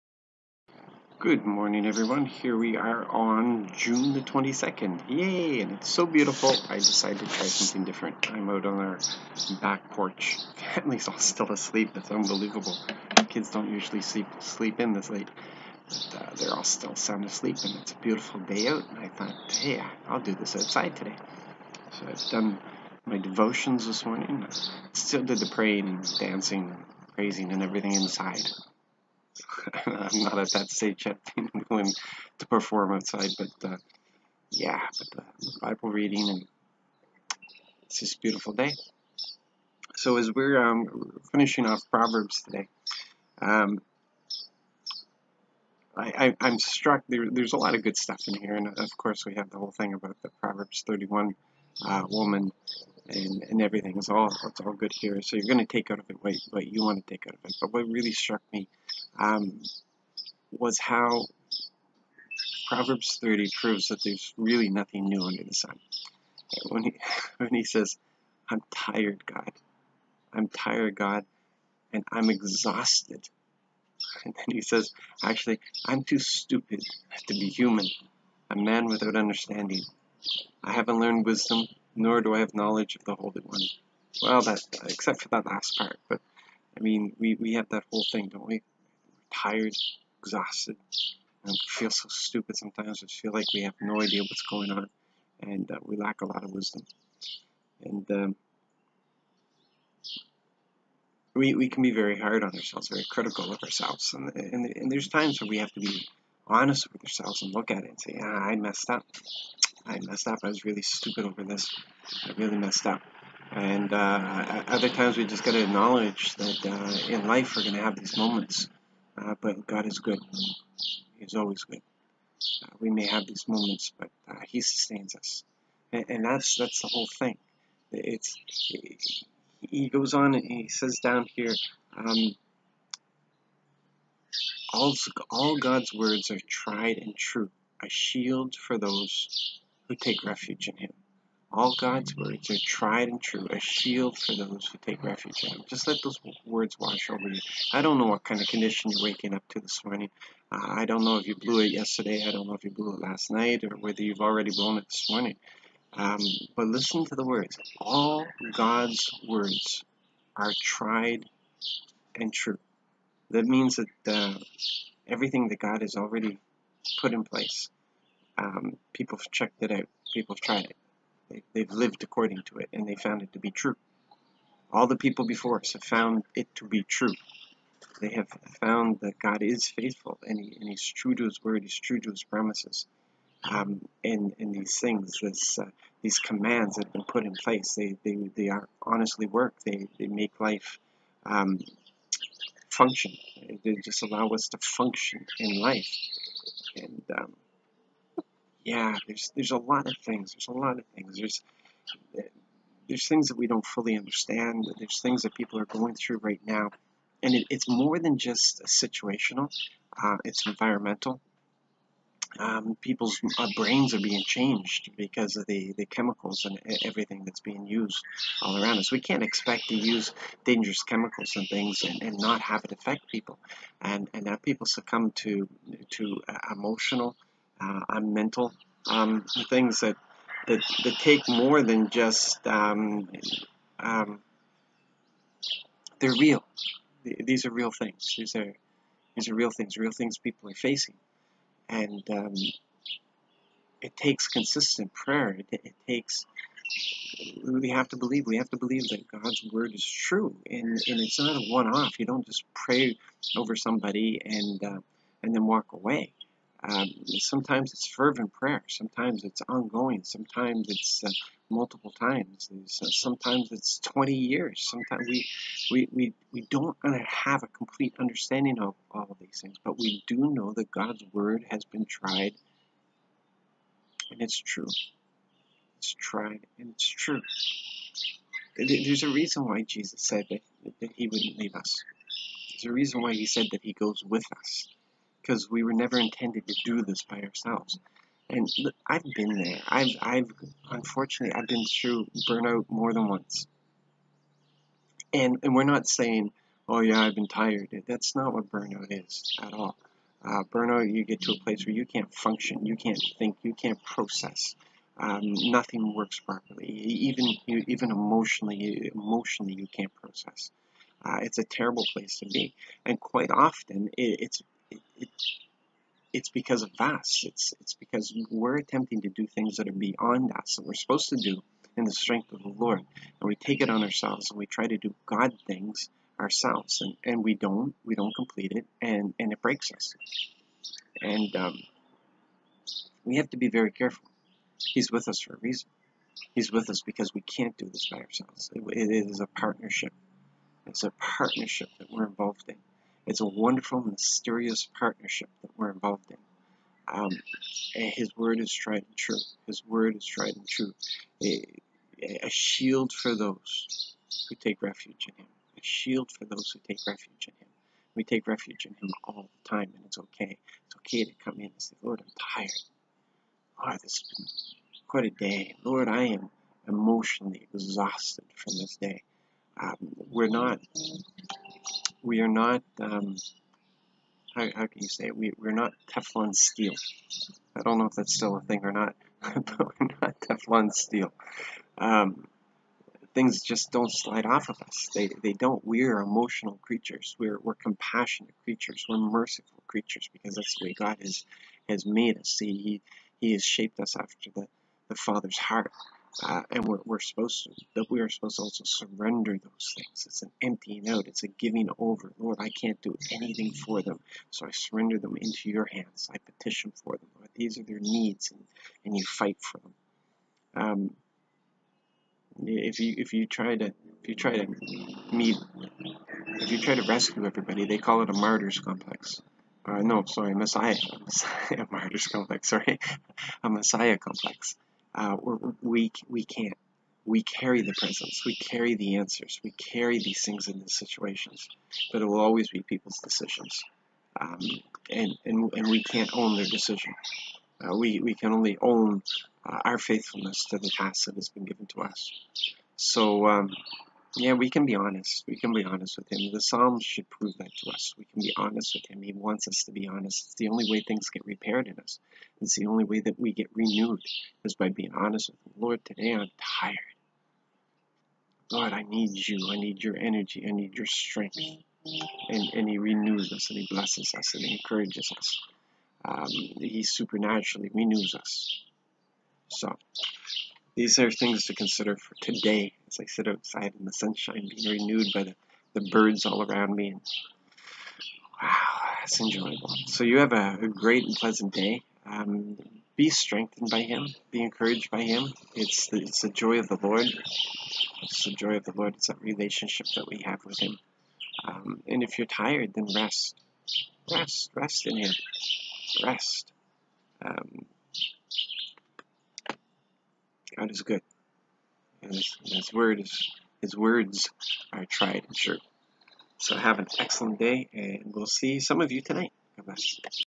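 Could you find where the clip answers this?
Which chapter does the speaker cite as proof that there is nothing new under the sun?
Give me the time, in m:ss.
1:02.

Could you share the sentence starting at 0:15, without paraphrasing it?
But, uh, they're all still sound asleep, and it's a beautiful day out.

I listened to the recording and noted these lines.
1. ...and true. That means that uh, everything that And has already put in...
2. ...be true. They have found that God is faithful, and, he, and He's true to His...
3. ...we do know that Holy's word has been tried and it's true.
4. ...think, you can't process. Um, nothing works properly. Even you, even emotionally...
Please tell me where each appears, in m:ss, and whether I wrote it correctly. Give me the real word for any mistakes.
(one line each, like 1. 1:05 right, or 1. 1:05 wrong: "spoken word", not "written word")
1. 2:42 wrong: "God", not "And"
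2. 2:56 right
3. 4:29 wrong: "God", not "Holy"
4. 5:03 right.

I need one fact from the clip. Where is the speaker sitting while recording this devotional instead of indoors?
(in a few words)
back porch.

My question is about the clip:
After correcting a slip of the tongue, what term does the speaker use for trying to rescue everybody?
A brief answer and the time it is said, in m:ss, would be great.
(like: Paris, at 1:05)
Messiah complex, at 7:03.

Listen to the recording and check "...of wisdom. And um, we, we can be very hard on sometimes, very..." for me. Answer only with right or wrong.
wrong.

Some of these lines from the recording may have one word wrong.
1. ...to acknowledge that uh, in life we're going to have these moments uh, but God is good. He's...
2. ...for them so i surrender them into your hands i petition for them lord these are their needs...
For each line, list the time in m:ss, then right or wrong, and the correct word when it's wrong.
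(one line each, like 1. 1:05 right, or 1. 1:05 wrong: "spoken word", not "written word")
1. 1:55 right
2. 6:43 right.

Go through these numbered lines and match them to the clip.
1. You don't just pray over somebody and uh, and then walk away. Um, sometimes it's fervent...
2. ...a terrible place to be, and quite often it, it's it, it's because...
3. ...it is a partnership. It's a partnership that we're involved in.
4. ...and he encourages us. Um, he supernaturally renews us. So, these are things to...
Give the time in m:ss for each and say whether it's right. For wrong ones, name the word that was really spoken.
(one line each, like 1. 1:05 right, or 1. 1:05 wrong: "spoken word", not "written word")
1. 4:11 right
2. 5:11 right
3. 5:38 right
4. 7:44 right.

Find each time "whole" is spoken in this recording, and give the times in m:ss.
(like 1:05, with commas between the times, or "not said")
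0:49, 1:27, 2:06.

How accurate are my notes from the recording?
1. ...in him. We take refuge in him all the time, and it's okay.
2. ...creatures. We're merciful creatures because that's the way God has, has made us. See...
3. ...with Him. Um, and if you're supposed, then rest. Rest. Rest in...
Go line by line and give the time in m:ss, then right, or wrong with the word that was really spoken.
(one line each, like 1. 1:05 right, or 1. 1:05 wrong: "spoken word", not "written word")
1. 5:57 right
2. 6:28 right
3. 8:10 wrong: "tired", not "supposed".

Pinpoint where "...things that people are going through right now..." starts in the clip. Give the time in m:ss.
3:25.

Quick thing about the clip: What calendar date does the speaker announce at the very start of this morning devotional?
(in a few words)
June 22.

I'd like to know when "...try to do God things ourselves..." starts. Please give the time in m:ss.
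5:24.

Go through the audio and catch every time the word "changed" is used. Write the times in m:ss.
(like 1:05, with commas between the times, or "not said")
3:34.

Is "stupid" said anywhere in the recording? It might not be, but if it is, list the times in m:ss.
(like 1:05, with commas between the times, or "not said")
1:16, 1:32, 1:50.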